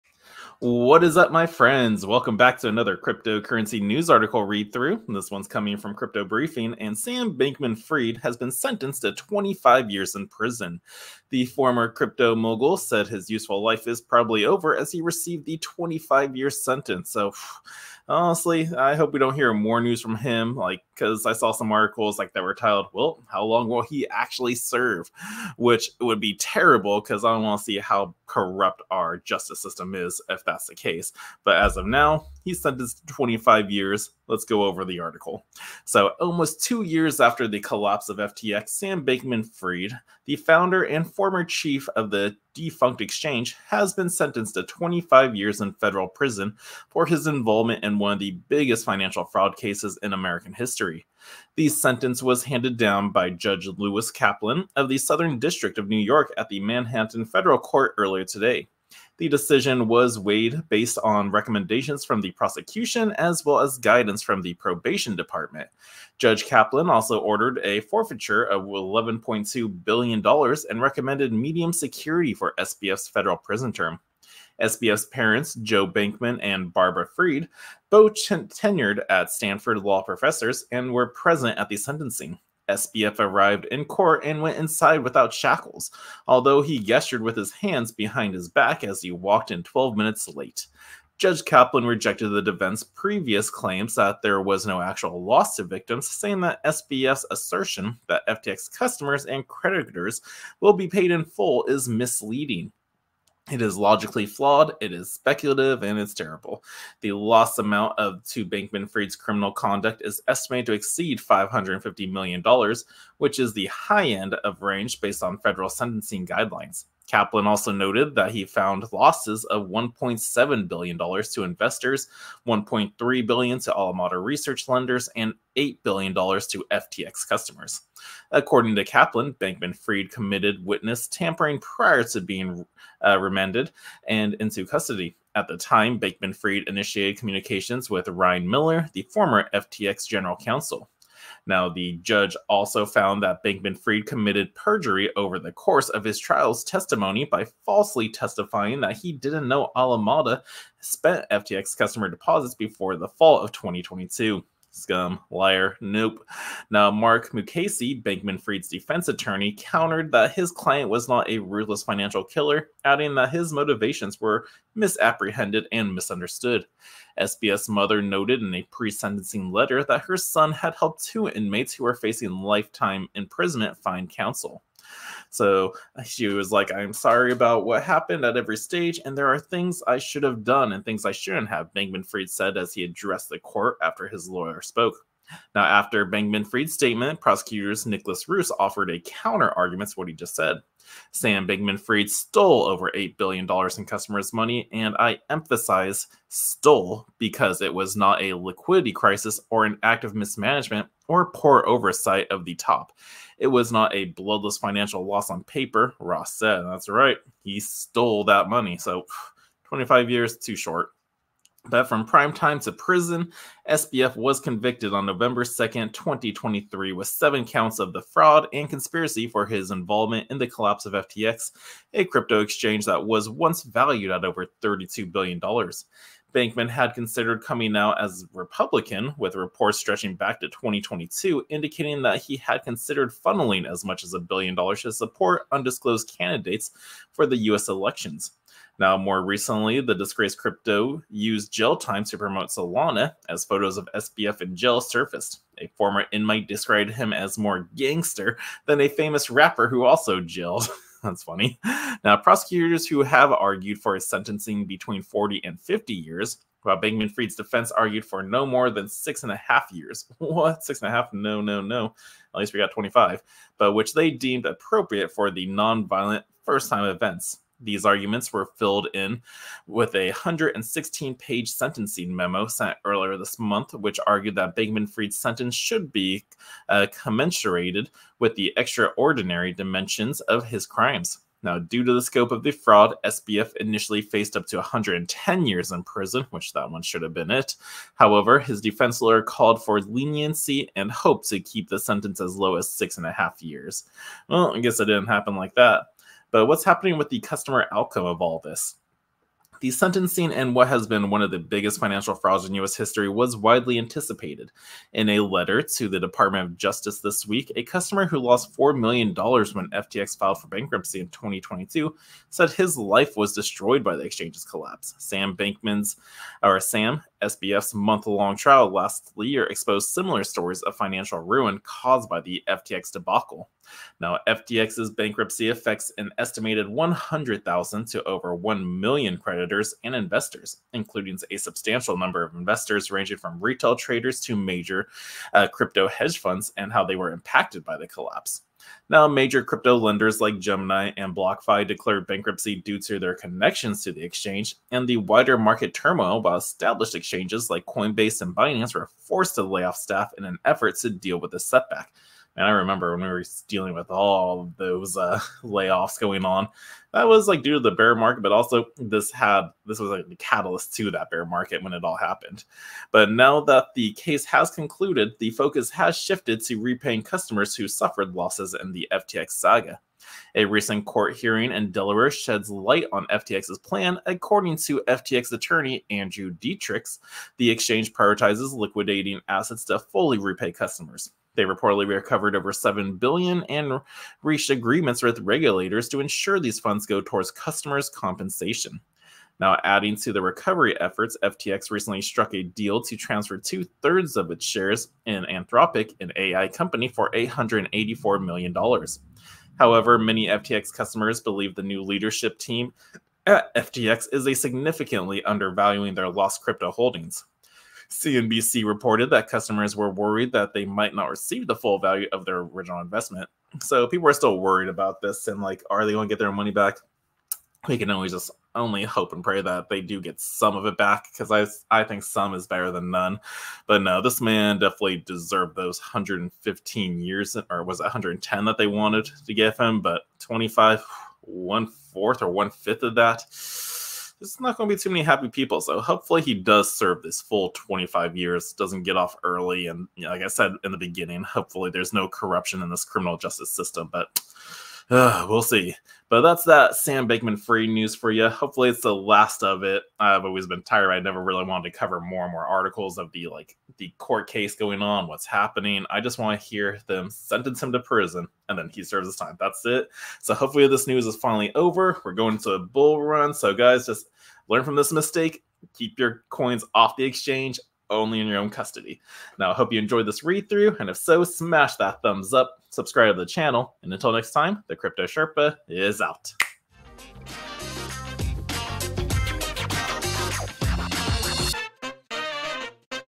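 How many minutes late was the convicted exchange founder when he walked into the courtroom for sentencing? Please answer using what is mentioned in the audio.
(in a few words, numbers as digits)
12.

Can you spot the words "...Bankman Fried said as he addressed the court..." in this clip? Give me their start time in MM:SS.
03:01.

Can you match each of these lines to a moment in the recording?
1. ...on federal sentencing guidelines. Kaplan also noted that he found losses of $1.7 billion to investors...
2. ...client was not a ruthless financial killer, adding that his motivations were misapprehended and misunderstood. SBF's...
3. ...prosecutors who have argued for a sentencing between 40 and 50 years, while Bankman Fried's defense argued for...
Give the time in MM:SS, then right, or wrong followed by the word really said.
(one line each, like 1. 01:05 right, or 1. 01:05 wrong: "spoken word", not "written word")
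1. 01:55 right
2. 02:40 right
3. 04:12 right.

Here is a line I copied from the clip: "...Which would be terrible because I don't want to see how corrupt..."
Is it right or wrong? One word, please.
right.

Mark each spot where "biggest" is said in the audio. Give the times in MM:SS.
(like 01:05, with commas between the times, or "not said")
00:48, 05:01.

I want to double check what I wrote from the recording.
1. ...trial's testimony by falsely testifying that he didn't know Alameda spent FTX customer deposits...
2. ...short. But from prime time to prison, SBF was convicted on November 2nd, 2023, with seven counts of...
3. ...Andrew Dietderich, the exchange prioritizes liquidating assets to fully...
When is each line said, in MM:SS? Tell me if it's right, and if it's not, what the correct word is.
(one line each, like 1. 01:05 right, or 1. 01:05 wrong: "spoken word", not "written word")
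1. 02:26 right
2. 03:30 right
3. 06:15 right.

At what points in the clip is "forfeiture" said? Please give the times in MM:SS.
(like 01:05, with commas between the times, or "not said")
01:07.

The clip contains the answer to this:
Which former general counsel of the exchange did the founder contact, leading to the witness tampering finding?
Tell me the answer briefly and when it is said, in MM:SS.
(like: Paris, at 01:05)
Ryan Miller, at 02:18.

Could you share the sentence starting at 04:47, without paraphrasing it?
However, his defense lawyer called for leniency and hoped to keep the sentence as low as six and a half years.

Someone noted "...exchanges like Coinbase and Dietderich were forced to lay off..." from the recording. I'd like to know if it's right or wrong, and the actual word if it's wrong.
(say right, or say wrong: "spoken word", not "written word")
wrong: "Binance", not "Dietderich".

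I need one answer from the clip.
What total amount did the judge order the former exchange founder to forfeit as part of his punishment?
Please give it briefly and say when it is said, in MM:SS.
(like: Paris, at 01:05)
$11.2 billion, at 01:08.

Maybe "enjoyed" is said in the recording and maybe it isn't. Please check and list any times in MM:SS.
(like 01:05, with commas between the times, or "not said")
07:49.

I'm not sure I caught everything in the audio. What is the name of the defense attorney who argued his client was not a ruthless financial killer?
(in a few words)
Mark Mukasey.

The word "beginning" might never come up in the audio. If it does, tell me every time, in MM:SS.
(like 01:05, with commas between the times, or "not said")
07:20.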